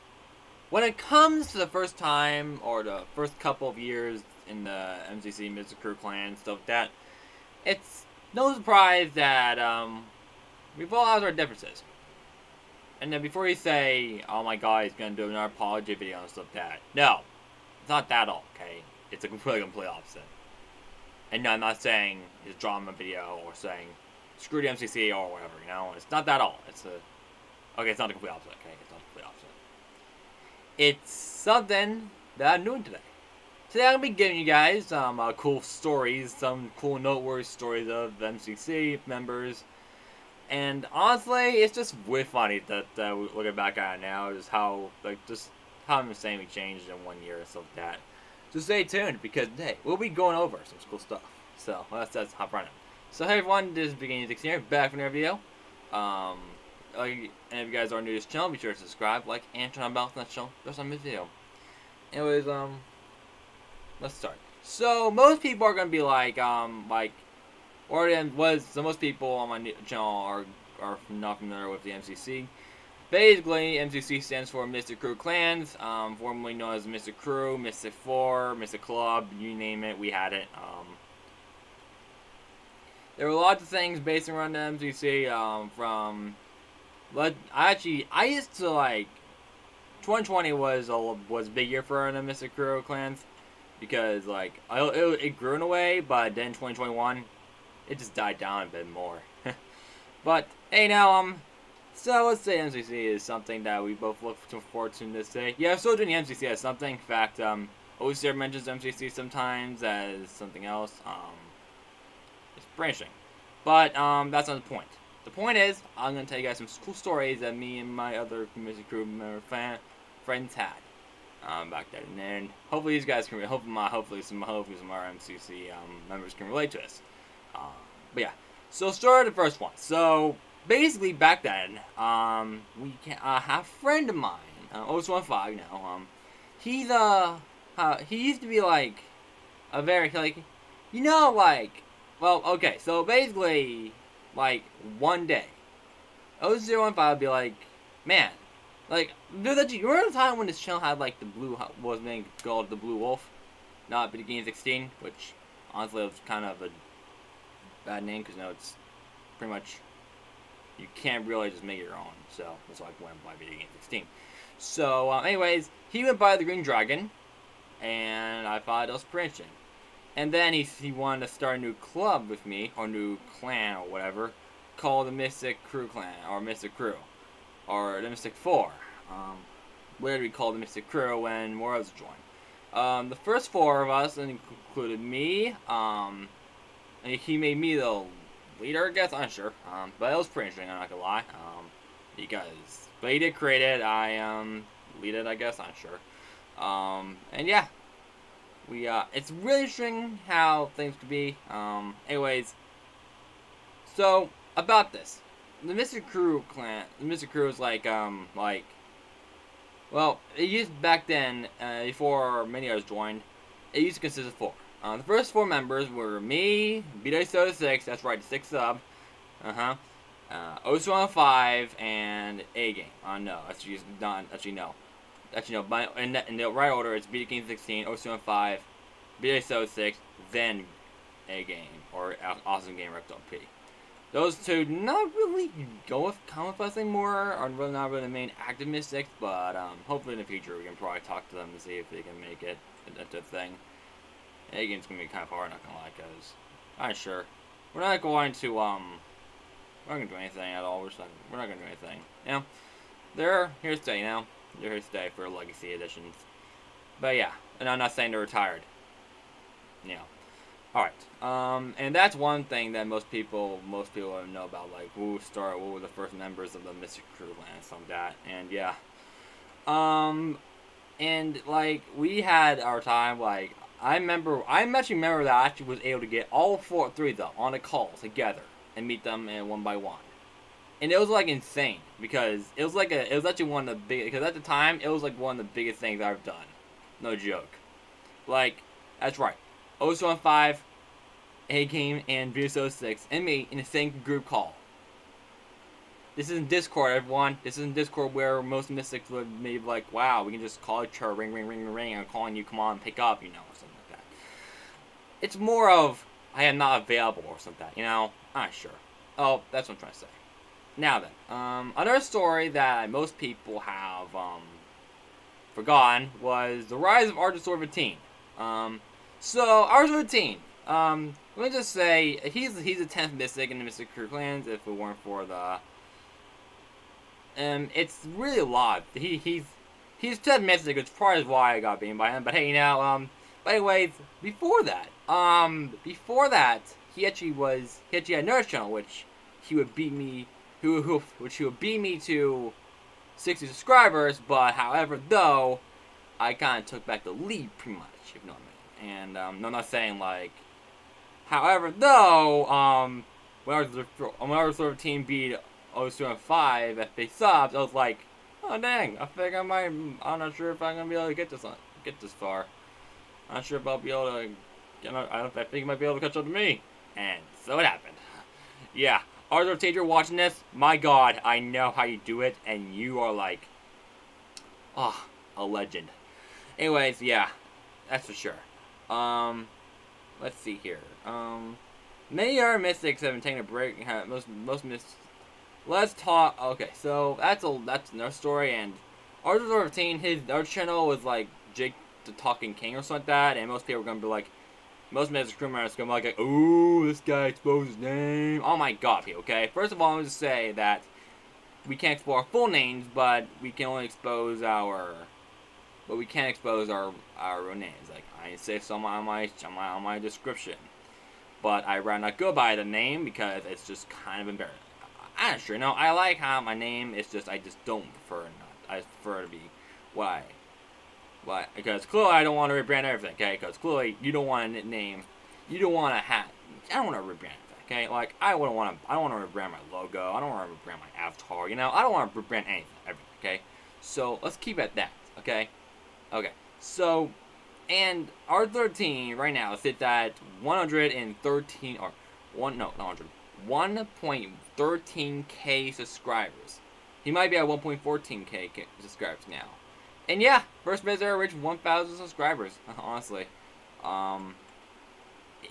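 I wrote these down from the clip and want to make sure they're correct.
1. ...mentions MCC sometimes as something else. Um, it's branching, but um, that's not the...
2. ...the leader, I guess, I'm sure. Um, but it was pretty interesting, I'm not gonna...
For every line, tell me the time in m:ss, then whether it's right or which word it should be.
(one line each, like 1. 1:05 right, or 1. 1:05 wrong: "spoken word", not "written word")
1. 1:48 right
2. 3:07 right.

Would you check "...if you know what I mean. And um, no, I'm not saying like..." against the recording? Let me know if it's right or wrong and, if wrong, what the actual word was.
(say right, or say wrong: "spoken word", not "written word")
right.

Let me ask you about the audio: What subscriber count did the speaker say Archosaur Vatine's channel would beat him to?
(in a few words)
60.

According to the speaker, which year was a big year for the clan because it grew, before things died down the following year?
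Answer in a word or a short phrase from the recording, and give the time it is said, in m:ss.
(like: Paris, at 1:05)
2020, at 1:30.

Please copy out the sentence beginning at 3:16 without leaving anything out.
Um, and yeah, we uh, it's really interesting how things could be.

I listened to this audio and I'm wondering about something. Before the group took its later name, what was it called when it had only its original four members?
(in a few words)
Mystic Four.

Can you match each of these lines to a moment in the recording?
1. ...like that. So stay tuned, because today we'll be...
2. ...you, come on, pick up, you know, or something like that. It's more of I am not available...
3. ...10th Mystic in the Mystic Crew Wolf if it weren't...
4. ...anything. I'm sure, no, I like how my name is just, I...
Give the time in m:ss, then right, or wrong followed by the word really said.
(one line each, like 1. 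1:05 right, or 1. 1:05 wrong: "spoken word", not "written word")
1. 0:47 right
2. 5:02 right
3. 5:22 wrong: "Clans", not "Wolf"
4. 6:54 wrong: "embarrassing", not "anything".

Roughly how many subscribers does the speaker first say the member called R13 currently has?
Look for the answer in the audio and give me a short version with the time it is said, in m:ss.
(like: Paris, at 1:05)
1.13k, at 7:24.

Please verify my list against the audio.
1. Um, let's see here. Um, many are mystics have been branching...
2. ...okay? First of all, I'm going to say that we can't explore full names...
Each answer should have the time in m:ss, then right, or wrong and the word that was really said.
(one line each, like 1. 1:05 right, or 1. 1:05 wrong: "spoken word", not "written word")
1. 6:18 wrong: "taking", not "branching"
2. 6:39 right.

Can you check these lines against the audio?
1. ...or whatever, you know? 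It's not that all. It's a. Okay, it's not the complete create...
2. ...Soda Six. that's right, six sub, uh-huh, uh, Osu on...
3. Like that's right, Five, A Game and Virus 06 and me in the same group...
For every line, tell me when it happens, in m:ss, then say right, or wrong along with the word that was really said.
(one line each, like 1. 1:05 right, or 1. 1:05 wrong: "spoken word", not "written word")
1. 0:25 wrong: "opposite", not "create"
2. 3:37 right
3. 4:48 right.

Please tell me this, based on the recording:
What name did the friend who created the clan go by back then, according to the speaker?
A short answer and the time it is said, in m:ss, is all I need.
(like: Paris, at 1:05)
Green Dragon, at 2:46.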